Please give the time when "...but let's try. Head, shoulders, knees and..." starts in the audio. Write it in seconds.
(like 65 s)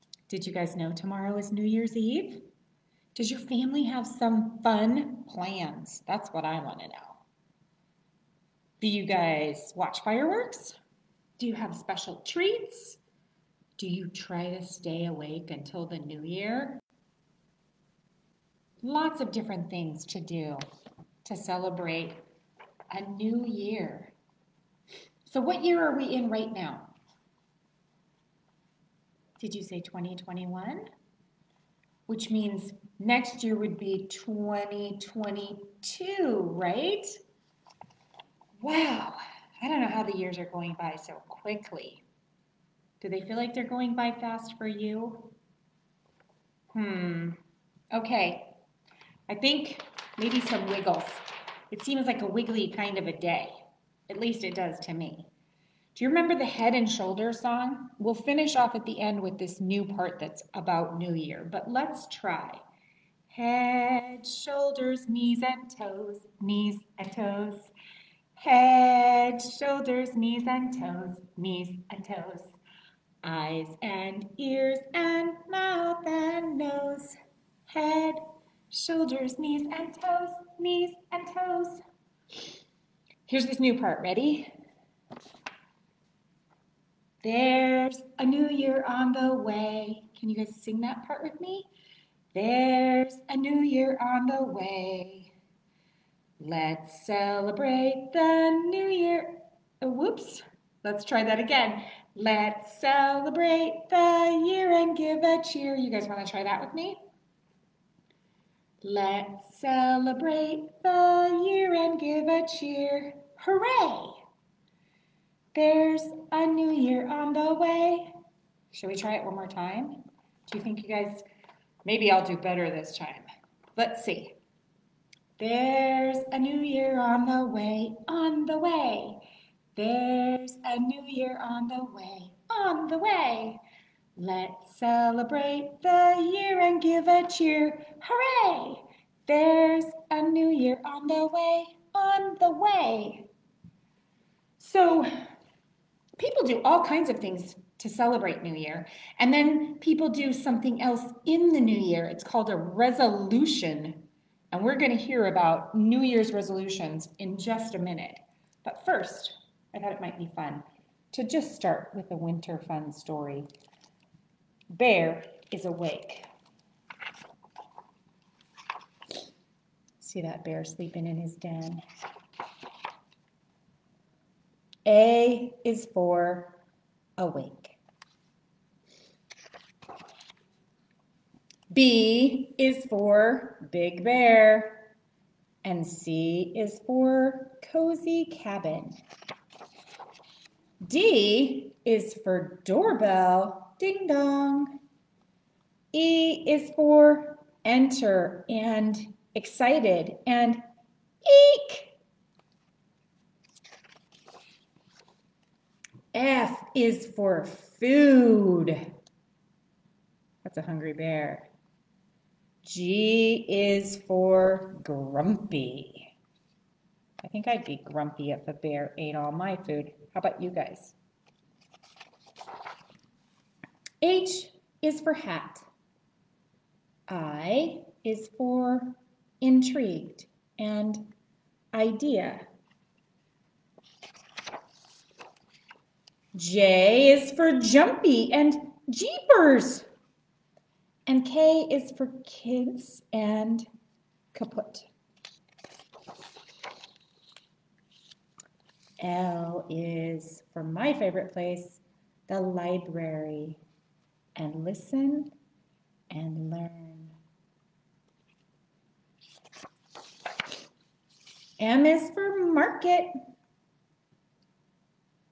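61 s.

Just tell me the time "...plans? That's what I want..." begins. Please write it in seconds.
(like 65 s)
5 s.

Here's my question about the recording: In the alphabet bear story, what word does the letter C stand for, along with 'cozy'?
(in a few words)
cabin.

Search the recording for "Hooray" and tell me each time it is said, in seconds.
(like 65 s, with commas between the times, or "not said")
113 s, 137 s.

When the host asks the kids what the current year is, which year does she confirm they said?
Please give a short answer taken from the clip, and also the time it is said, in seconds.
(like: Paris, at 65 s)
2021, at 29 s.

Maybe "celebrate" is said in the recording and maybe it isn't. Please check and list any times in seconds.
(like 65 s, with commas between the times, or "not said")
21 s, 97 s, 102 s, 109 s, 134 s, 147 s.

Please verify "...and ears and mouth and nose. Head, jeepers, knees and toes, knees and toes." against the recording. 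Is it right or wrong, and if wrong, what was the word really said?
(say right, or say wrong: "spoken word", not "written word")
wrong: "shoulders", not "jeepers".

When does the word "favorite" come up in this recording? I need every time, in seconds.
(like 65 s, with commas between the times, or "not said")
250 s.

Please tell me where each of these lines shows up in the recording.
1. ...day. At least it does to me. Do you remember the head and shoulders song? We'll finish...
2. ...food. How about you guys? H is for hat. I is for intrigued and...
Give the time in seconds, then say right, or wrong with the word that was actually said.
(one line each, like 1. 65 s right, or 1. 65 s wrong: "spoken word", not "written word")
1. 53 s right
2. 219 s right.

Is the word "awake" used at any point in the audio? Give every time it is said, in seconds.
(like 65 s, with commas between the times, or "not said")
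15 s, 165 s, 177 s.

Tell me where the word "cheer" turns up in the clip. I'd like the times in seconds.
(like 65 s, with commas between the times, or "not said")
105 s, 112 s, 137 s.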